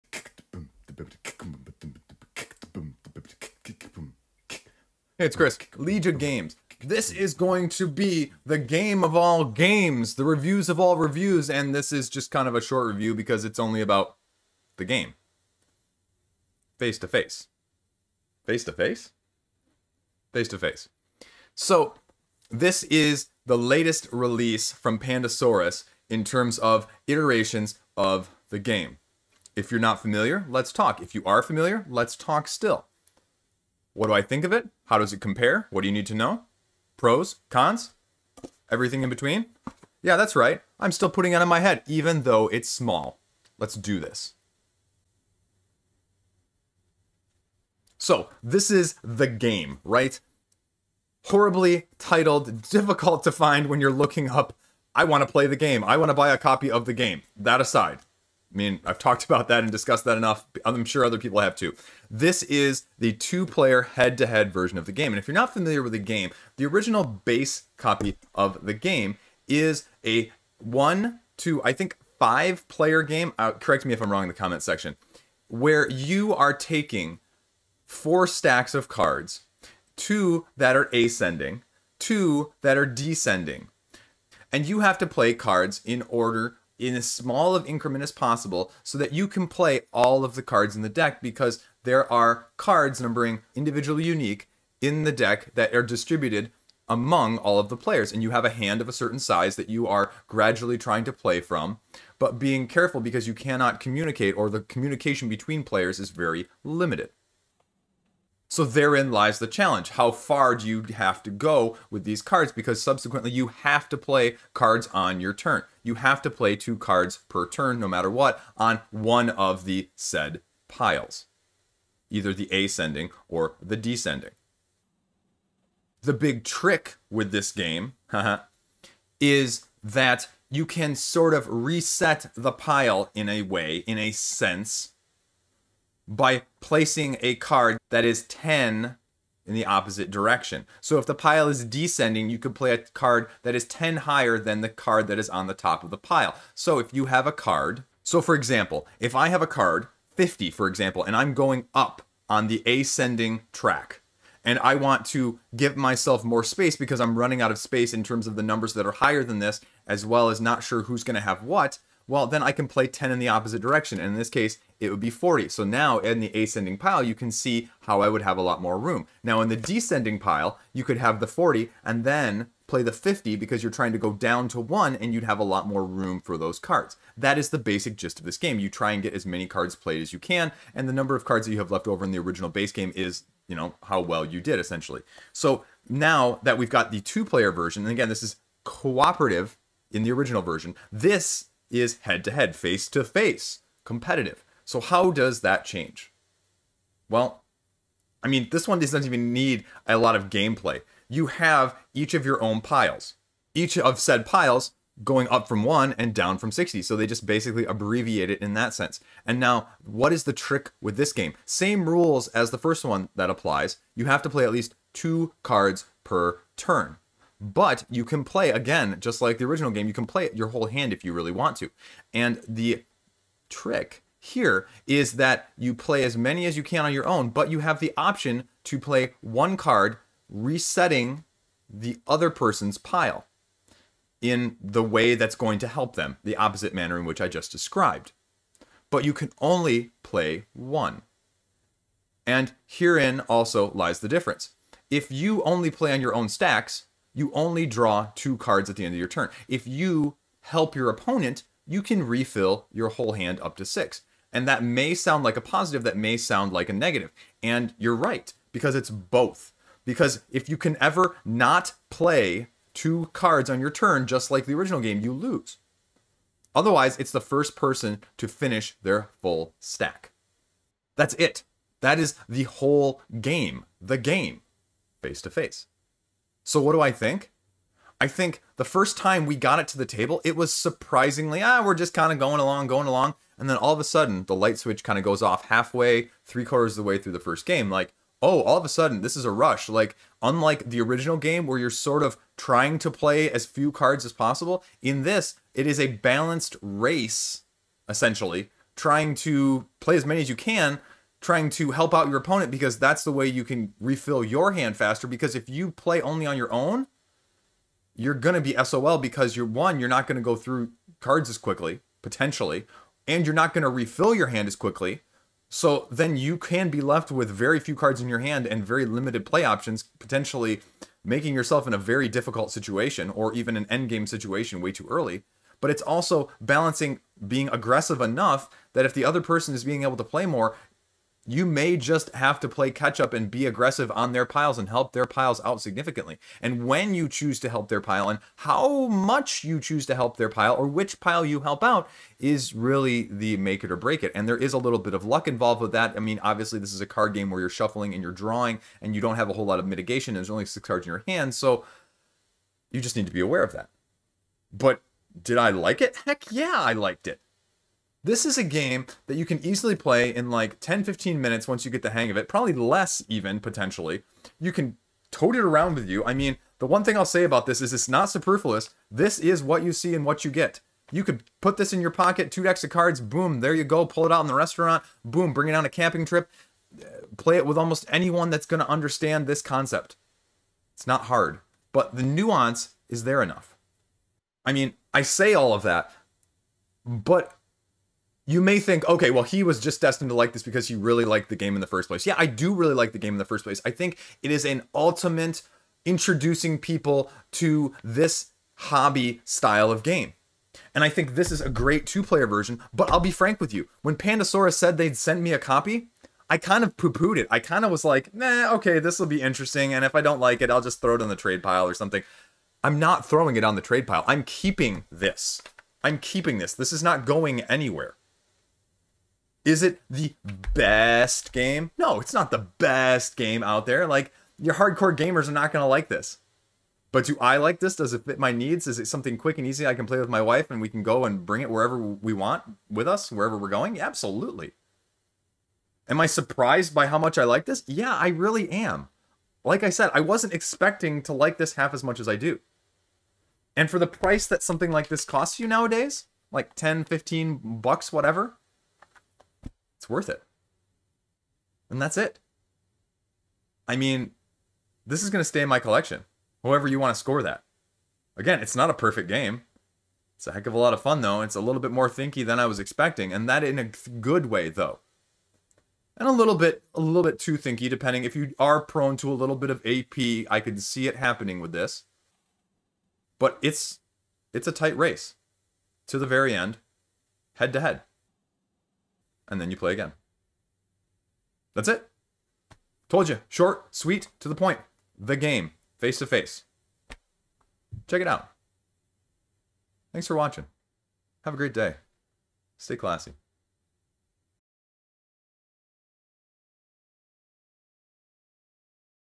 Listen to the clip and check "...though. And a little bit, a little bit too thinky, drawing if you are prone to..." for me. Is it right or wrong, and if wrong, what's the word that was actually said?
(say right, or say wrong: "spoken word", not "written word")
wrong: "depending", not "drawing".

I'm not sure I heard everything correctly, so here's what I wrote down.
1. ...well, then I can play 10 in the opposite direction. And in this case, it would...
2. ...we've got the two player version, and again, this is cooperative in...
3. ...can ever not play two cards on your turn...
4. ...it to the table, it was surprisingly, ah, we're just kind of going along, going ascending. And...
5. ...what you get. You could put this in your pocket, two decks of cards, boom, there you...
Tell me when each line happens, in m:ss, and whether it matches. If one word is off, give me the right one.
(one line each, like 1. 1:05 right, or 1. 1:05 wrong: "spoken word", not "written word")
1. 2:42 right
2. 3:06 right
3. 4:20 right
4. 4:39 wrong: "along", not "ascending"
5. 6:10 right.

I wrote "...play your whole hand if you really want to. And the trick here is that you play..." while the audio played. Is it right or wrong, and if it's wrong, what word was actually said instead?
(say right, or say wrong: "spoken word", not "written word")
right.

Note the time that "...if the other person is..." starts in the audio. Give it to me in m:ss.
5:28.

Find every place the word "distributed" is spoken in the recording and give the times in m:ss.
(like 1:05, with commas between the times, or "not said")
1:35.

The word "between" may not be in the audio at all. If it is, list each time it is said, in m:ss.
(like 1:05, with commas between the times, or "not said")
0:39, 1:45.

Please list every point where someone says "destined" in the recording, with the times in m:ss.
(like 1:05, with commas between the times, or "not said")
6:29.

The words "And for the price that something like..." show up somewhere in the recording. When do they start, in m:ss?
7:23.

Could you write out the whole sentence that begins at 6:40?
And I think this is a great two player version, but I'll be frank with you.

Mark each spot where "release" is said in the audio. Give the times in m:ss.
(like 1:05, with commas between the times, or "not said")
0:24.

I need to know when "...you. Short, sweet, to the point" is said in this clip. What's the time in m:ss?
8:03.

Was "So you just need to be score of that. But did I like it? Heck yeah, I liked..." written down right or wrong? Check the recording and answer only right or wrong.
wrong.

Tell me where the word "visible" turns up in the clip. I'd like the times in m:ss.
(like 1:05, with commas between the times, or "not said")
not said.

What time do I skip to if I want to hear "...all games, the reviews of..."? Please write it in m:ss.
0:09.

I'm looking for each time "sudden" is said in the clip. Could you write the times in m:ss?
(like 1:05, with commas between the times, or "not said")
4:43, 4:48.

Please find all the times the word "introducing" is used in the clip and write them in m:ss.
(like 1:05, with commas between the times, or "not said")
6:35.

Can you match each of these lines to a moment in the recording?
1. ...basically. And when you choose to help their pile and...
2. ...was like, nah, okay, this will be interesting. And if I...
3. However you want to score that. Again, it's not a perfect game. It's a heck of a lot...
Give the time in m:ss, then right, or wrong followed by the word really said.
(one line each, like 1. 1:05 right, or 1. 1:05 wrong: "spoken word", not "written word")
1. 5:35 wrong: "significantly", not "basically"
2. 6:47 right
3. 7:36 right.